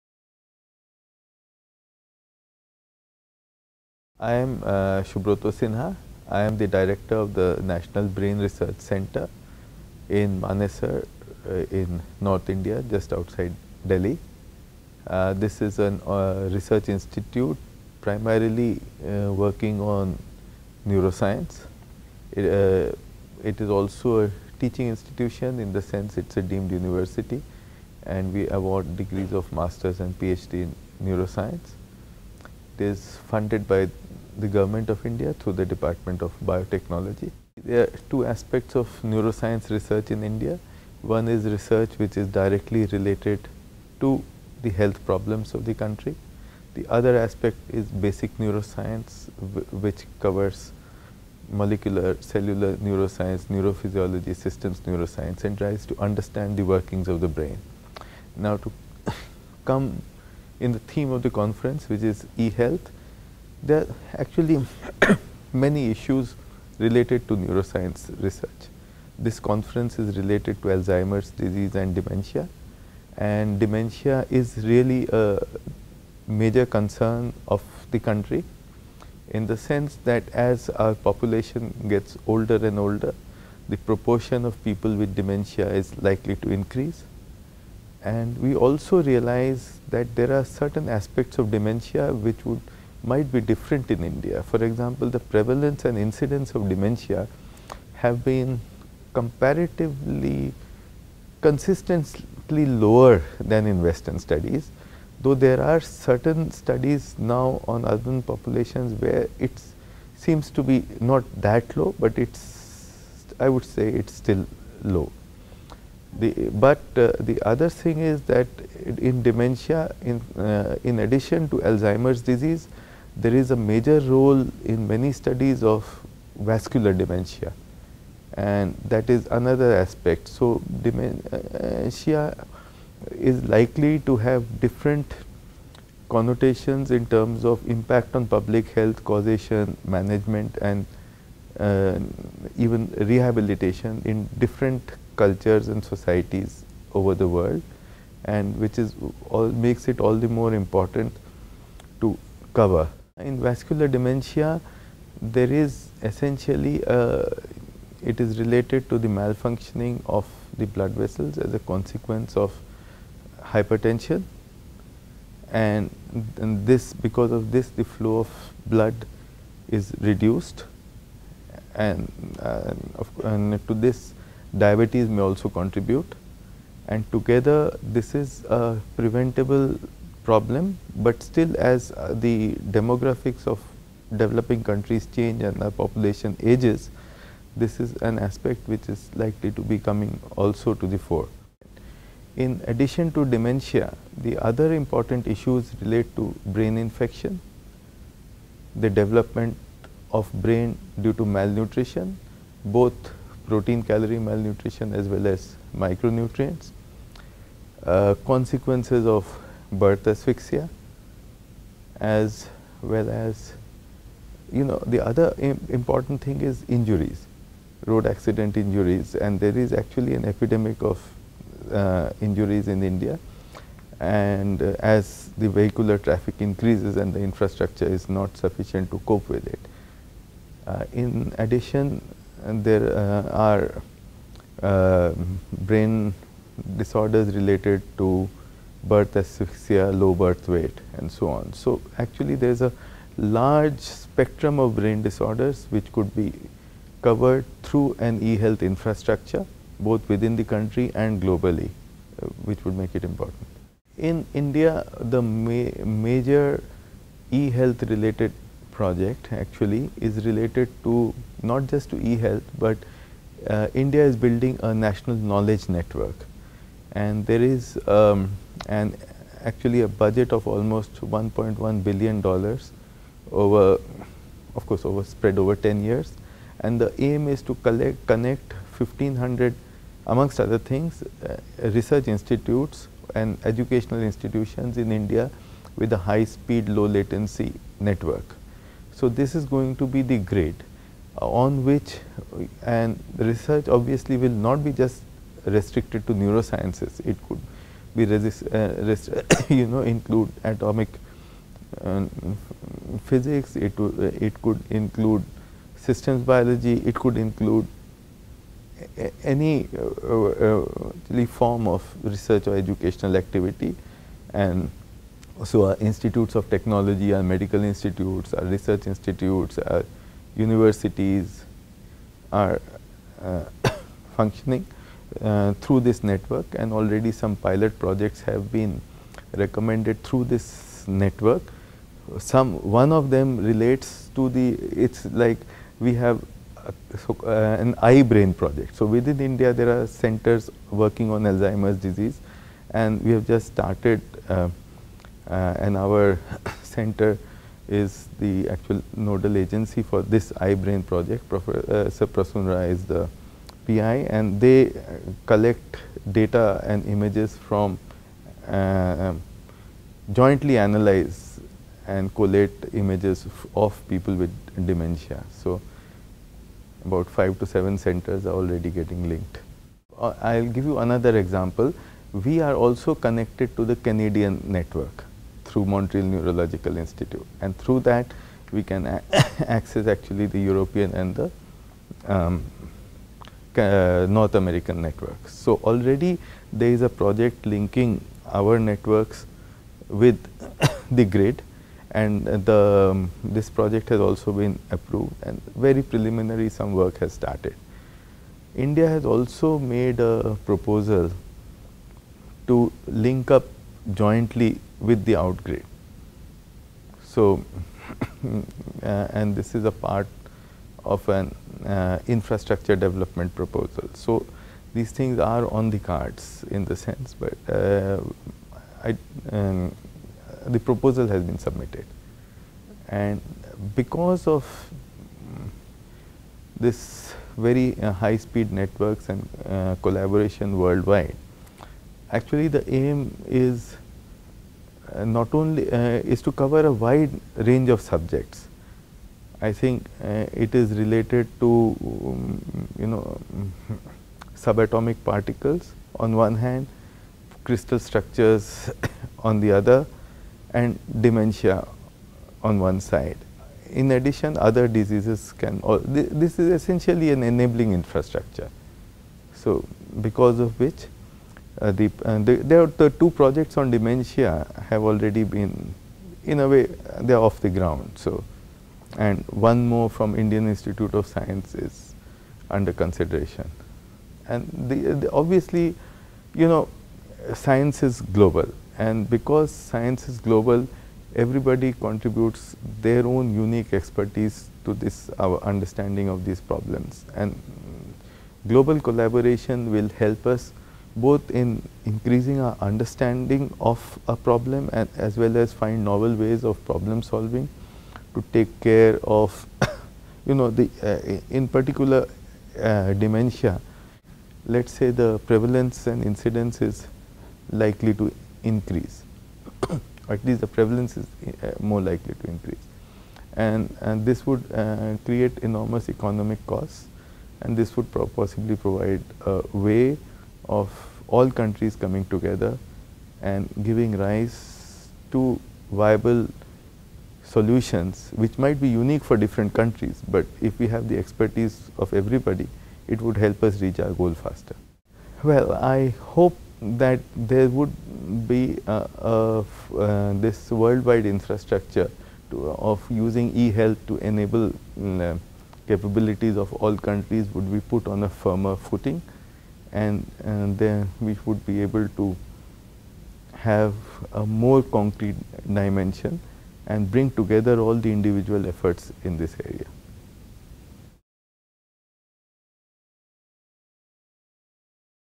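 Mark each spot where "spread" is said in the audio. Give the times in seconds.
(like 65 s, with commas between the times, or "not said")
275 s.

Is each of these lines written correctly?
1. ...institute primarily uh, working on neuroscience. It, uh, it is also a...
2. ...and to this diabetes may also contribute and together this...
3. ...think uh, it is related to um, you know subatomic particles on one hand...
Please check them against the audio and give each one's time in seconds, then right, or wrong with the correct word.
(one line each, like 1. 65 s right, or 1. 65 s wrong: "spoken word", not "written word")
1. 16 s right
2. 173 s right
3. 439 s right.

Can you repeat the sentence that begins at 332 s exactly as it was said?
Some one of them relates to the it's like we have uh, so, uh, an eye brain project.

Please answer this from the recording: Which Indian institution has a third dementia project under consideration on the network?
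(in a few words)
Indian Institute of Science.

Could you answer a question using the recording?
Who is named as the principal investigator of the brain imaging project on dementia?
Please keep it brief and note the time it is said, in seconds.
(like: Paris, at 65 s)
Prasun Roy, at 352 s.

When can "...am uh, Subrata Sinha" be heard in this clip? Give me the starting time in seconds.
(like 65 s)
4 s.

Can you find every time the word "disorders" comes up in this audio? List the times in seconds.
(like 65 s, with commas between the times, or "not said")
236 s, 245 s.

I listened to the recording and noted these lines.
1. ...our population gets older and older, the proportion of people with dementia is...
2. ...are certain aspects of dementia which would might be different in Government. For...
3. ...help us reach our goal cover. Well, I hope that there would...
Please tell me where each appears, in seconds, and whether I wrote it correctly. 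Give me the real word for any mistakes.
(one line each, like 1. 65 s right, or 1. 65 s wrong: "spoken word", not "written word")
1. 80 s right
2. 90 s wrong: "India", not "Government"
3. 533 s wrong: "faster", not "cover".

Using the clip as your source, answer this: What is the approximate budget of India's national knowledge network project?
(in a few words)
1.1 billion dollars.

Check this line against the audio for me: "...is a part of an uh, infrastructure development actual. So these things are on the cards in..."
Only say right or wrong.
wrong.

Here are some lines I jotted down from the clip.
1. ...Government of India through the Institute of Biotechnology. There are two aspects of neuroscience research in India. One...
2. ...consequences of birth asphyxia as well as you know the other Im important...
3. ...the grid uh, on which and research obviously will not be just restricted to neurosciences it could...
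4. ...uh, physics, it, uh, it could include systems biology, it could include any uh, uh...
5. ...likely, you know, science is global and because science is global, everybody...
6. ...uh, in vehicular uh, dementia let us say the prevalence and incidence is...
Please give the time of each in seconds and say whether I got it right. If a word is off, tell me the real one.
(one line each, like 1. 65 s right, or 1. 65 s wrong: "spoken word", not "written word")
1. 34 s wrong: "Department", not "Institute"
2. 208 s right
3. 290 s right
4. 301 s right
5. 475 s wrong: "obviously", not "likely"
6. 500 s wrong: "particular", not "vehicular".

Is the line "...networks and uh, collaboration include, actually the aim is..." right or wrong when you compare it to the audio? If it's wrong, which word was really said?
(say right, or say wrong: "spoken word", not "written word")
wrong: "worldwide", not "include".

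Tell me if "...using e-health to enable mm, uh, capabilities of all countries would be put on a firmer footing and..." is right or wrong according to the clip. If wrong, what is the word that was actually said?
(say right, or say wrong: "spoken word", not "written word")
right.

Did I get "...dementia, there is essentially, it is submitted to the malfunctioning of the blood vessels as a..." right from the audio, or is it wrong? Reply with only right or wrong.
wrong.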